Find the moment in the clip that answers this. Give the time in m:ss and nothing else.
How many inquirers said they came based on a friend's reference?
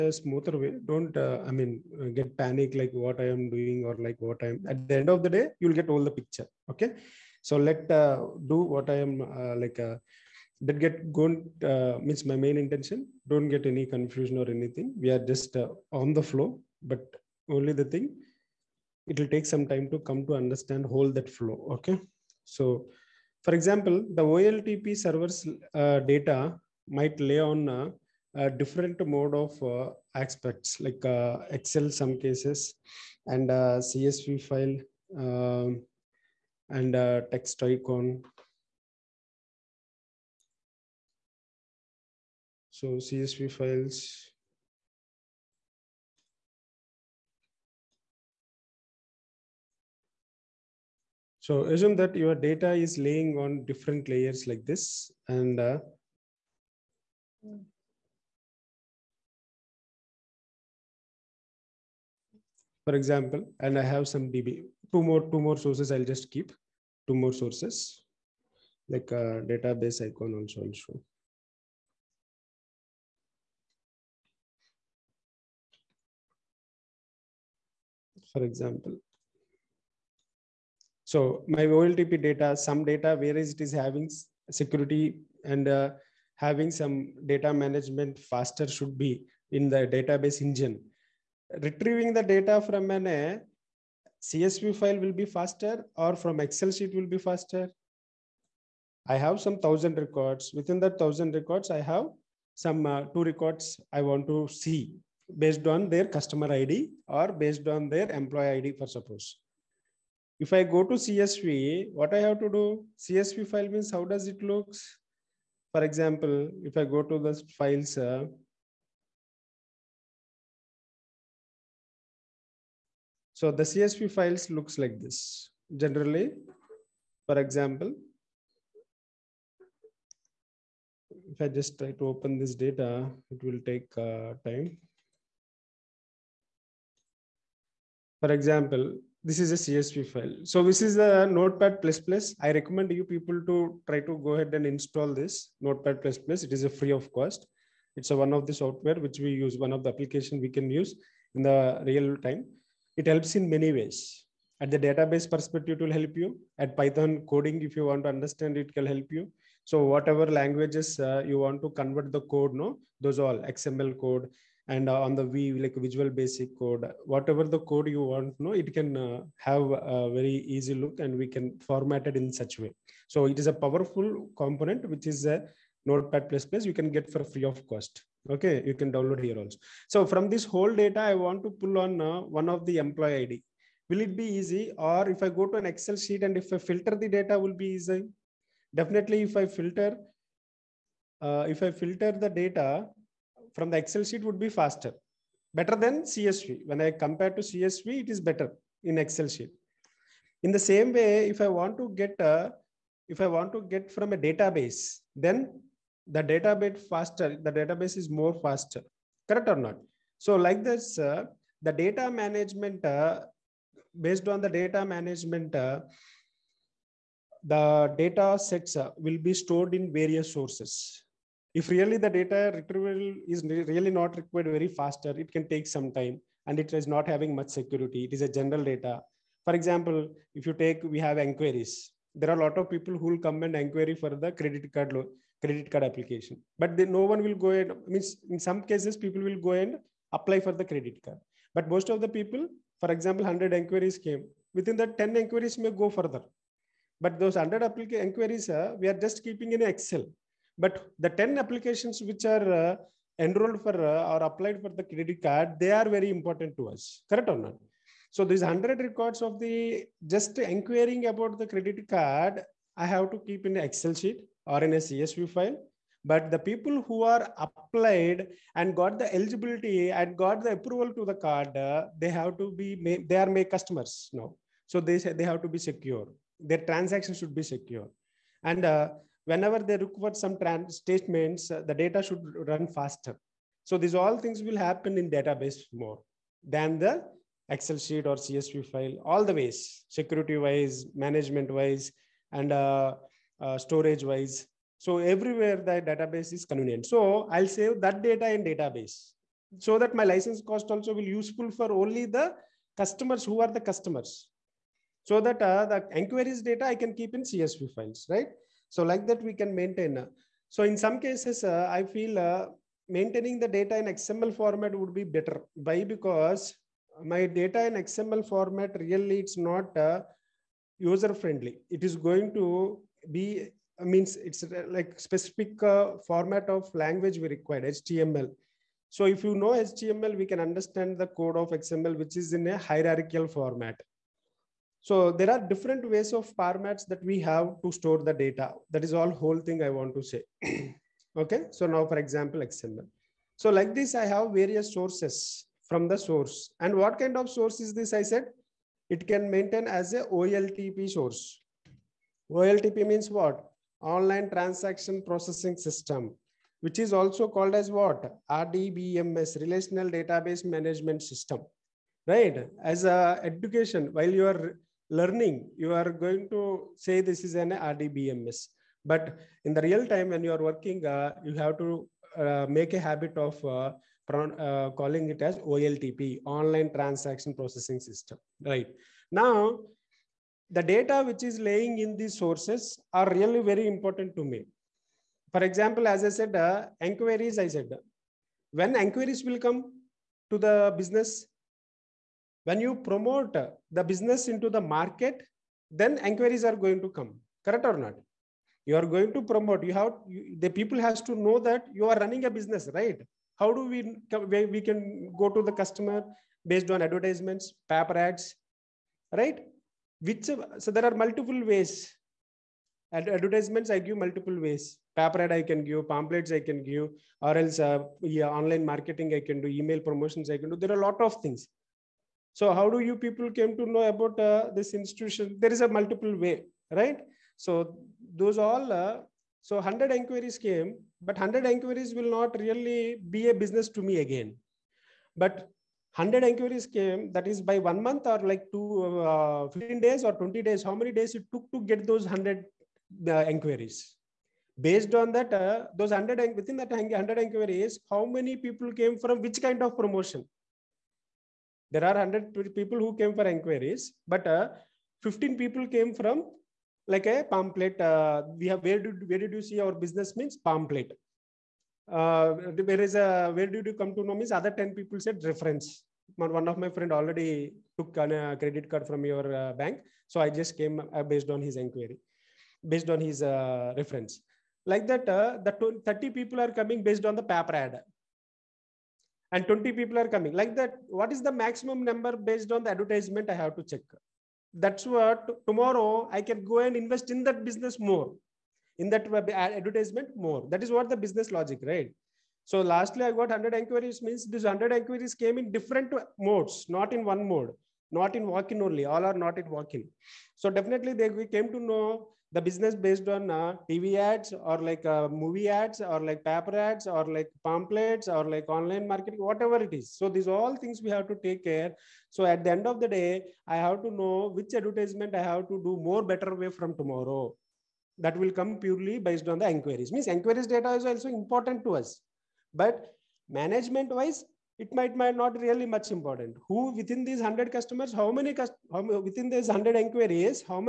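7:44.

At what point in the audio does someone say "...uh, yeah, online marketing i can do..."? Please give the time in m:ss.
6:57.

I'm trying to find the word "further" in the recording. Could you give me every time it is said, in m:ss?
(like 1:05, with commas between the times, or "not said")
4:05.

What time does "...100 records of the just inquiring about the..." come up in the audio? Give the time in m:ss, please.
4:18.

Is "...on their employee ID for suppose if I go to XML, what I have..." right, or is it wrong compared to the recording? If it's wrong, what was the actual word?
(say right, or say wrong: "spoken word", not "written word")
wrong: "CSV", not "XML".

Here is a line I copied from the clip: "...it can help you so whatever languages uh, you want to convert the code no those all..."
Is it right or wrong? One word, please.
right.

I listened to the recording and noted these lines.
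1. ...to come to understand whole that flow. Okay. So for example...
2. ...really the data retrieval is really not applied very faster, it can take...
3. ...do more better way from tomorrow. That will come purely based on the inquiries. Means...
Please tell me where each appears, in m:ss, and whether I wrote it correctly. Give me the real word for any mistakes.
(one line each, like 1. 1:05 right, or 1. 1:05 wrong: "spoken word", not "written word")
1. 0:19 right
2. 3:41 wrong: "required", not "applied"
3. 8:35 right.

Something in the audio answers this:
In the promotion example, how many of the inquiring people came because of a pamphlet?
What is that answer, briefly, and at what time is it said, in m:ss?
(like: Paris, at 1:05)
15, at 7:35.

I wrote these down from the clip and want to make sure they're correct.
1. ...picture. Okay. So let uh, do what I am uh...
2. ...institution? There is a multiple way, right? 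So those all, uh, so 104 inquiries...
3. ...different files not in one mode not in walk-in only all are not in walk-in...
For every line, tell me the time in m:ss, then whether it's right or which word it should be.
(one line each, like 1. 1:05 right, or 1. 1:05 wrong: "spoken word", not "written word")
1. 0:06 right
2. 7:04 wrong: "100", not "104"
3. 8:15 wrong: "modes", not "files".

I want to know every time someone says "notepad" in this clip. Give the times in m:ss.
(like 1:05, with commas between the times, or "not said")
2:21, 2:25, 2:55.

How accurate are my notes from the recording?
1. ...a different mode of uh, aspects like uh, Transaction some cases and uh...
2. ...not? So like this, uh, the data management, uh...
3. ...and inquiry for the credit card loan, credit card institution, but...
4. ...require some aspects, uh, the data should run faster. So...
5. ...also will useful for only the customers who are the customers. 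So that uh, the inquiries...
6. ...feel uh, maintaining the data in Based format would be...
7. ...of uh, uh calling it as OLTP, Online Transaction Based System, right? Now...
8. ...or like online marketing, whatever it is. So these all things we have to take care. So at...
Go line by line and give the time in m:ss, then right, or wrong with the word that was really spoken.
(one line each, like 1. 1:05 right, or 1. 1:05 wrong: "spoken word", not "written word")
1. 0:28 wrong: "Excel", not "Transaction"
2. 3:29 right
3. 3:53 wrong: "application", not "institution"
4. 4:39 wrong: "statements", not "aspects"
5. 5:00 right
6. 5:11 wrong: "XML", not "Based"
7. 6:13 wrong: "Processing", not "Based"
8. 8:28 right.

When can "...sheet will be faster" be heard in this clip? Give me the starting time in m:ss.
1:36.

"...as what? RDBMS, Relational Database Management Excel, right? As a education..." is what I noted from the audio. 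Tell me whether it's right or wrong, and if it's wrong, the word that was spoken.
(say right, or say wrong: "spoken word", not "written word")
wrong: "System", not "Excel".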